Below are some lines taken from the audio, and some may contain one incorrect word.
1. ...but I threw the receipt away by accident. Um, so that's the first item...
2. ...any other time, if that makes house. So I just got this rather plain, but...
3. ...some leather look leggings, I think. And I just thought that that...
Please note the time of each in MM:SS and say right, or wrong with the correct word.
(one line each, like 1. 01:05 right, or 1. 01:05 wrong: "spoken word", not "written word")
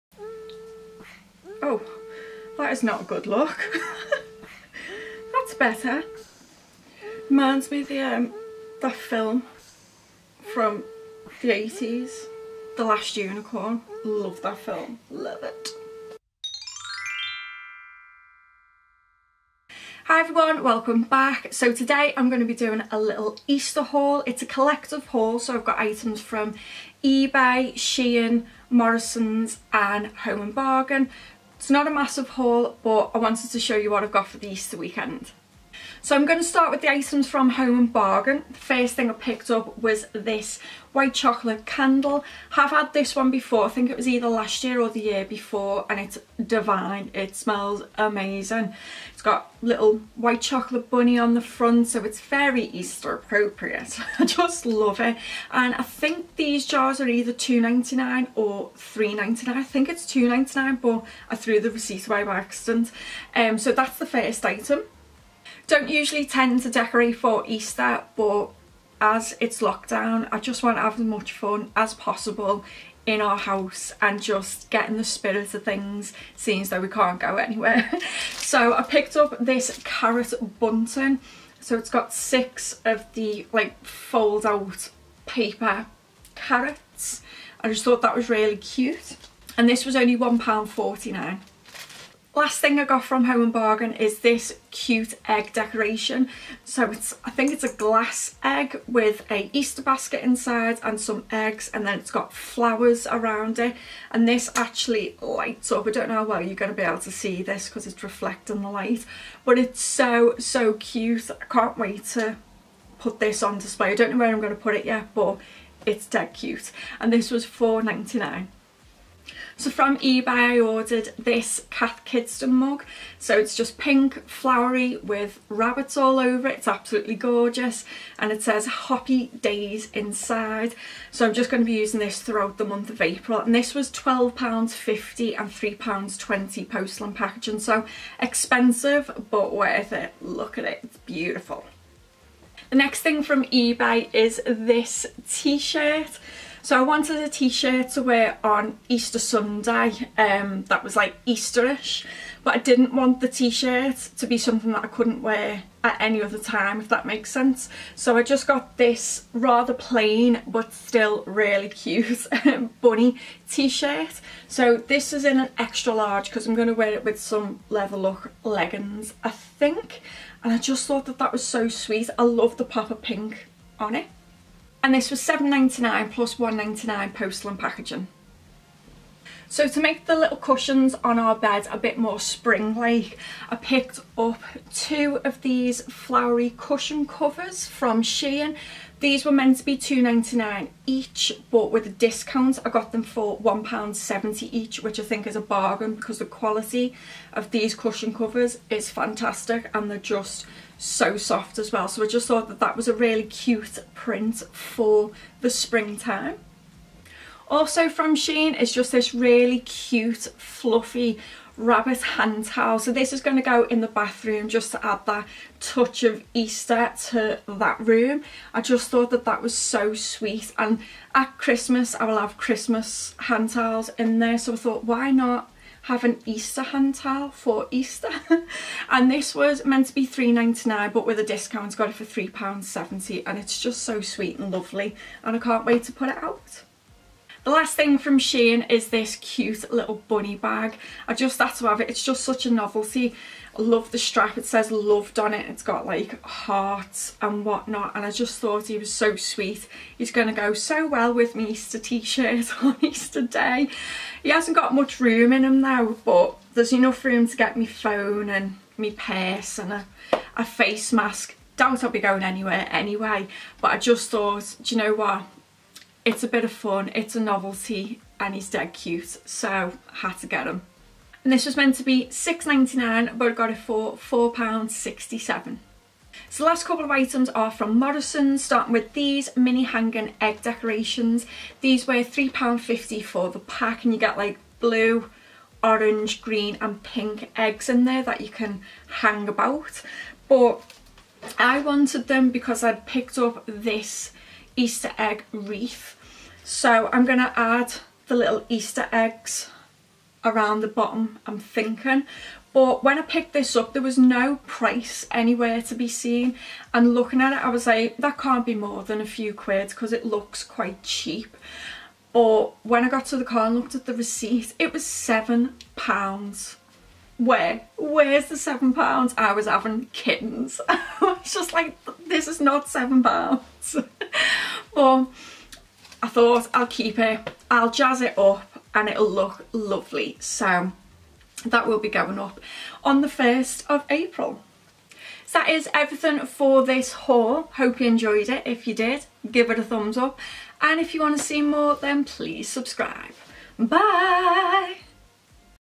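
1. 01:00 right
2. 02:35 wrong: "sense", not "house"
3. 02:47 right.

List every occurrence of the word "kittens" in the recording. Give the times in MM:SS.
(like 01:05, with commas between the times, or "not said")
05:19.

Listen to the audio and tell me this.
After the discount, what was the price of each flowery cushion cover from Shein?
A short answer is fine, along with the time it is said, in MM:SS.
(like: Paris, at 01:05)
£1.70, at 03:13.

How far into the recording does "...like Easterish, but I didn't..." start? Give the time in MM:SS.
02:30.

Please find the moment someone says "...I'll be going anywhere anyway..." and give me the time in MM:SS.
04:21.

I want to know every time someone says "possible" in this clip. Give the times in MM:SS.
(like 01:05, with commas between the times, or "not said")
01:11.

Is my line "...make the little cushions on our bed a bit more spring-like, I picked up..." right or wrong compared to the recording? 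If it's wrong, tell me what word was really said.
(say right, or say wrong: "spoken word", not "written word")
right.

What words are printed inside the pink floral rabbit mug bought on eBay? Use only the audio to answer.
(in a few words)
Hoppy Days.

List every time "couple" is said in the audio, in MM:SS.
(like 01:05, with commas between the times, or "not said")
04:36.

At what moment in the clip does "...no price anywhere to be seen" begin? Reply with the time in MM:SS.
05:03.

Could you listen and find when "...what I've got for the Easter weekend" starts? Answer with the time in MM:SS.
00:33.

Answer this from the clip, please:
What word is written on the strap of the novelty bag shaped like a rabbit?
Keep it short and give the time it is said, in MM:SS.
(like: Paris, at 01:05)
loved, at 04:04.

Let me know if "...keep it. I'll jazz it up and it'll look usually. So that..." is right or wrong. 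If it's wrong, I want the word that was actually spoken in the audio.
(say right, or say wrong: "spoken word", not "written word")
wrong: "lovely", not "usually".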